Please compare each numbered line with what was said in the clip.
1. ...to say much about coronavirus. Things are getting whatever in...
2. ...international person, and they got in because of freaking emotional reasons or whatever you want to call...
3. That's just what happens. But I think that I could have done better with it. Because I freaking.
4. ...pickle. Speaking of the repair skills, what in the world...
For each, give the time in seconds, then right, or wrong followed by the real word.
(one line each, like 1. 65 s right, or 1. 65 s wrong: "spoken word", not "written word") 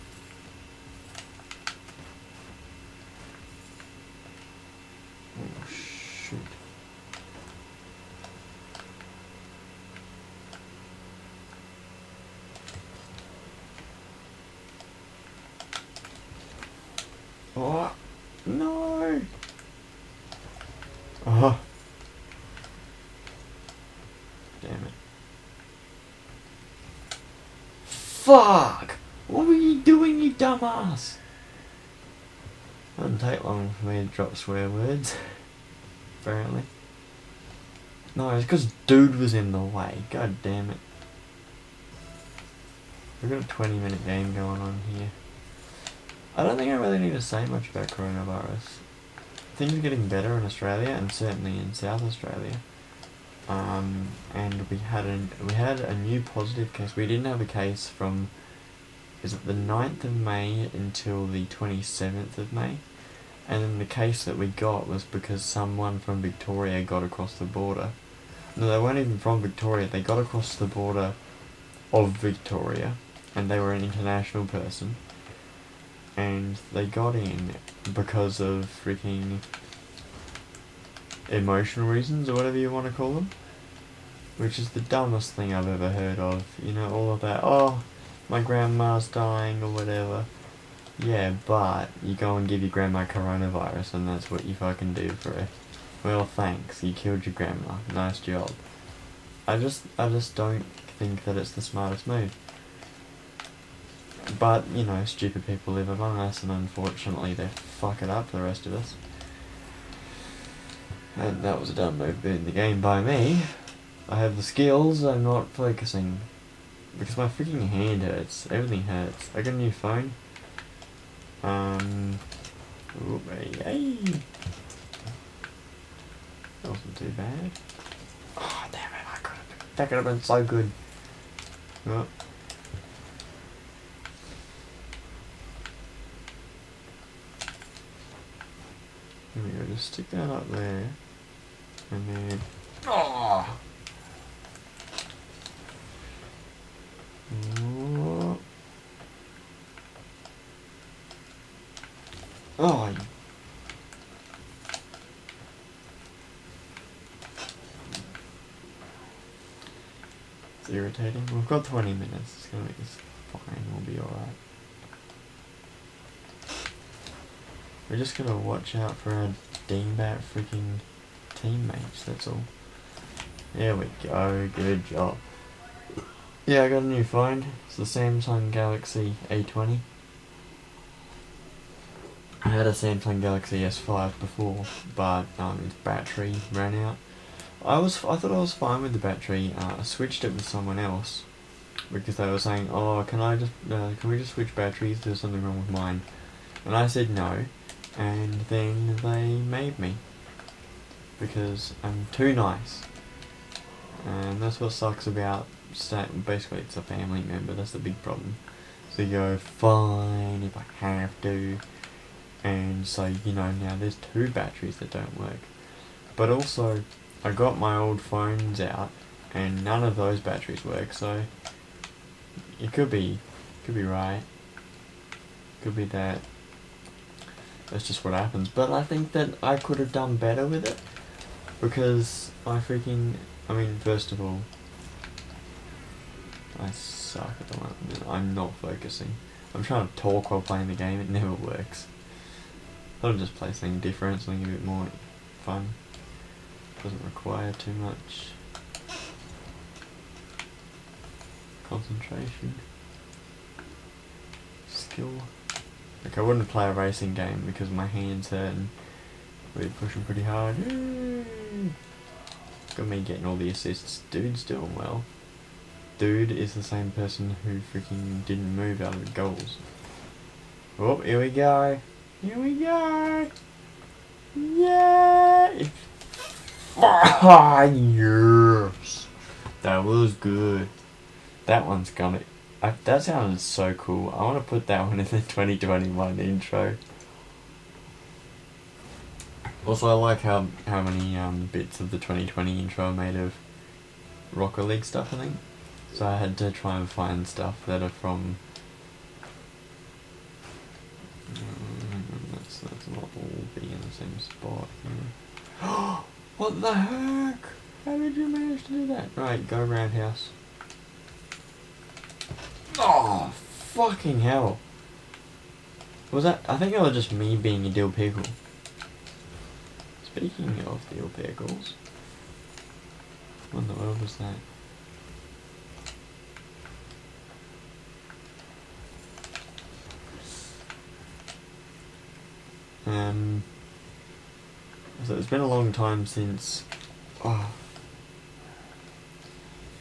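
1. 47 s wrong: "better", not "whatever"
2. 73 s right
3. 227 s right
4. 317 s wrong: "calls", not "skills".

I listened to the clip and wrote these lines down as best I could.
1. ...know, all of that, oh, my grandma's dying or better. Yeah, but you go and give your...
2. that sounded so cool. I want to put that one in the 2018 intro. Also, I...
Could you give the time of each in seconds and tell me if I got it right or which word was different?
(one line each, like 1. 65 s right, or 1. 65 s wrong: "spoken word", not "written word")
1. 86 s wrong: "whatever", not "better"
2. 282 s wrong: "2021", not "2018".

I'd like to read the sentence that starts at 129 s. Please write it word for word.
That could have been so good.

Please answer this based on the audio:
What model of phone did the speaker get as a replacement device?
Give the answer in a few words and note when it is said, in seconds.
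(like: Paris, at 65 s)
Samsung Galaxy A20, at 177 s.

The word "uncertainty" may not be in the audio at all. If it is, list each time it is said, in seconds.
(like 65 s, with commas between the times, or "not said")
not said.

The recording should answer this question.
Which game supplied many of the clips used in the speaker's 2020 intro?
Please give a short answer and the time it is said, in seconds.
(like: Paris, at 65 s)
Rocket League, at 294 s.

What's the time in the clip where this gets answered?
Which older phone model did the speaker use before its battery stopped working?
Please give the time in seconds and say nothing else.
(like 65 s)
182 s.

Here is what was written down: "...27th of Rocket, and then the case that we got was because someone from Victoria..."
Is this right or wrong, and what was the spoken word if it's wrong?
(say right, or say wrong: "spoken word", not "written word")
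wrong: "May", not "Rocket".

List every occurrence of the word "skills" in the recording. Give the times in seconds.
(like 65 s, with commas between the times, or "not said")
114 s, 254 s.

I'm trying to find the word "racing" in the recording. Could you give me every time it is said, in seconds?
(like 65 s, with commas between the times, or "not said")
256 s.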